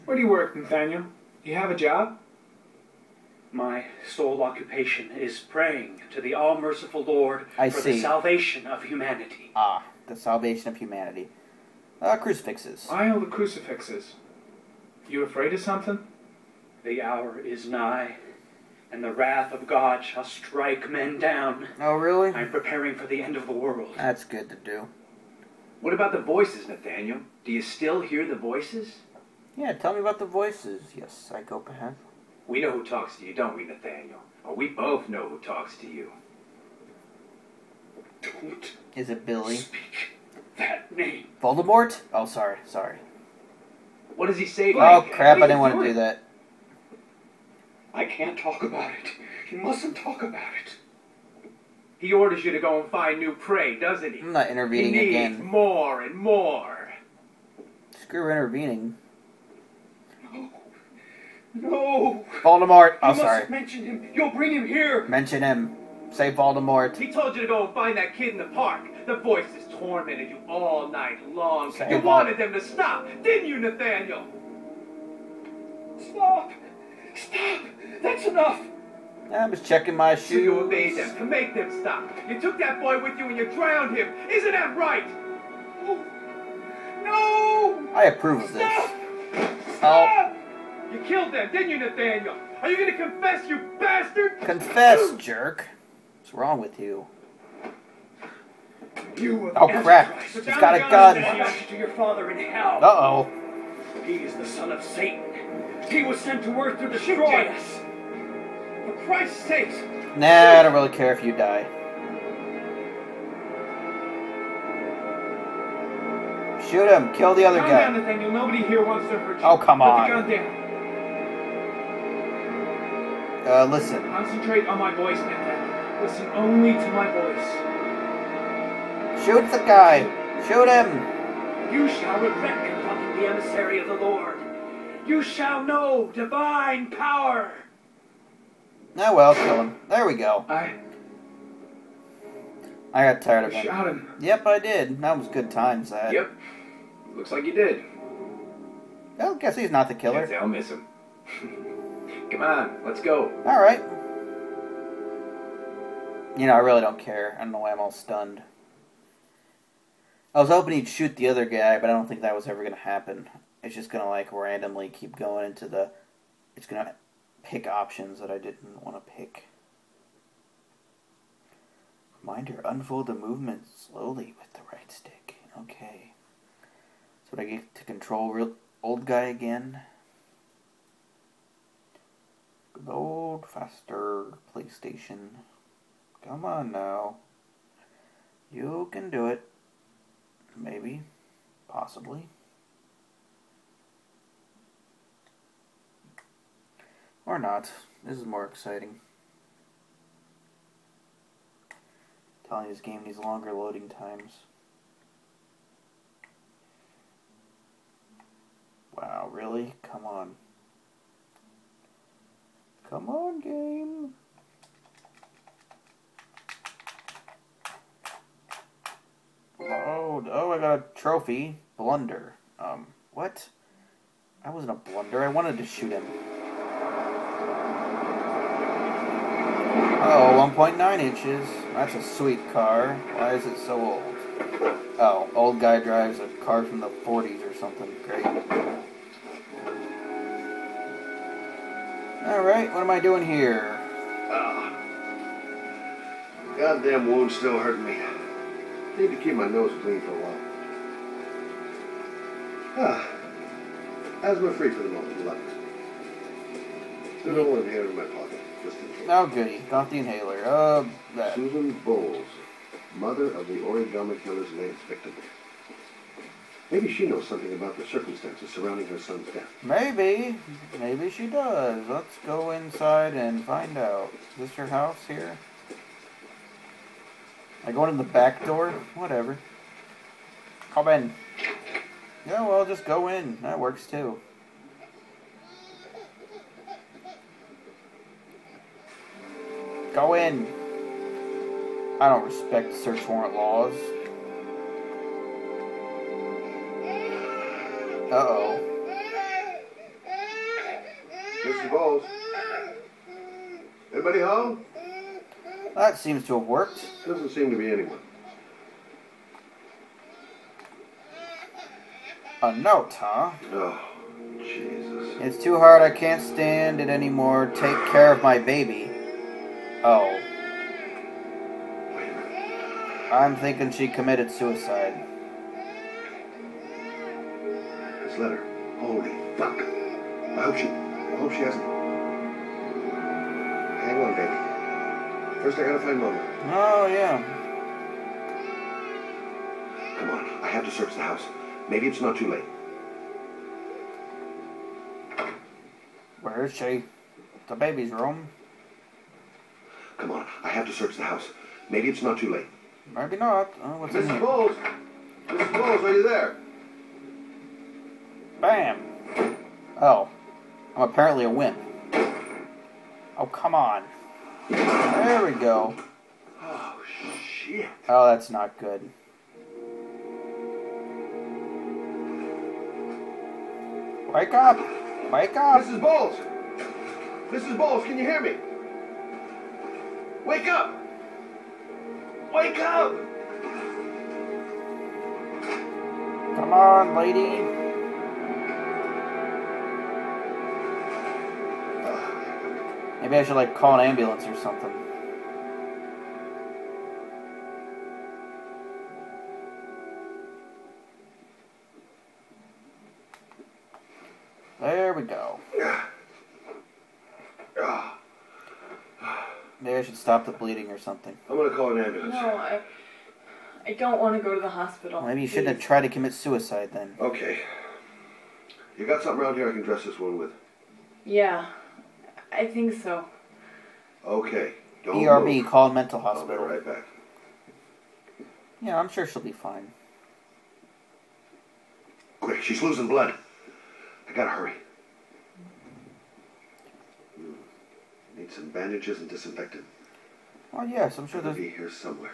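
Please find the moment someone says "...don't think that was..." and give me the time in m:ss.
2:41.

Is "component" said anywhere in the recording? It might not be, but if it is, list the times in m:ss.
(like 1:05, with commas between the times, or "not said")
not said.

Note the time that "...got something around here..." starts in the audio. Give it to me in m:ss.
6:58.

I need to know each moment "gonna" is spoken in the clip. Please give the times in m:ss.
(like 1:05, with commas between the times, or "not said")
1:32, 6:51.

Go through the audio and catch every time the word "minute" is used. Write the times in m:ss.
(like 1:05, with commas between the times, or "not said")
not said.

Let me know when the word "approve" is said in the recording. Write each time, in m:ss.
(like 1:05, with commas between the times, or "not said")
1:28.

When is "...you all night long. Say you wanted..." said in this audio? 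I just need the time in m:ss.
1:10.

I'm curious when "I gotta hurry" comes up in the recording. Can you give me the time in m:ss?
7:14.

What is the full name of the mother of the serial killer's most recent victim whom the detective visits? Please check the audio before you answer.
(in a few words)
Susan Bowles.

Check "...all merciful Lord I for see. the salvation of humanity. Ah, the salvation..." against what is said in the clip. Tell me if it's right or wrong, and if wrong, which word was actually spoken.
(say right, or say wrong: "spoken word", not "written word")
right.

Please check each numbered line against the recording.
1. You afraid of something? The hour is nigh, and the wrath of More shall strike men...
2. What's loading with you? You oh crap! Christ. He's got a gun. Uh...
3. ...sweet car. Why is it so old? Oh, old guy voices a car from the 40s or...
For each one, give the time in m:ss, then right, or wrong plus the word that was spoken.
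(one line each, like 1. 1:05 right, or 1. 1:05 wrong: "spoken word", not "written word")
1. 0:15 wrong: "God", not "More"
2. 1:36 wrong: "wrong", not "loading"
3. 3:52 wrong: "drives", not "voices".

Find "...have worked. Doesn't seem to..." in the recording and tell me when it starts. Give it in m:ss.
5:06.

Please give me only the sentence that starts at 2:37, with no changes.
I don't know why I'm all stunned.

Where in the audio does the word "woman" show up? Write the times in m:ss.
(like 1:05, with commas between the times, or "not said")
not said.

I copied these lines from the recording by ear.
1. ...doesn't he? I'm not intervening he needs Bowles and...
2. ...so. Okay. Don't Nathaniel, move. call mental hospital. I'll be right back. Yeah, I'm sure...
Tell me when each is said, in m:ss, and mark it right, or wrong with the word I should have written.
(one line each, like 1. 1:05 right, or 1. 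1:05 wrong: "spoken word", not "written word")
1. 0:53 wrong: "More", not "Bowles"
2. 7:02 wrong: "ERB", not "Nathaniel".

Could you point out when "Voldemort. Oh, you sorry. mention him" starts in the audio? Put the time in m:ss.
1:02.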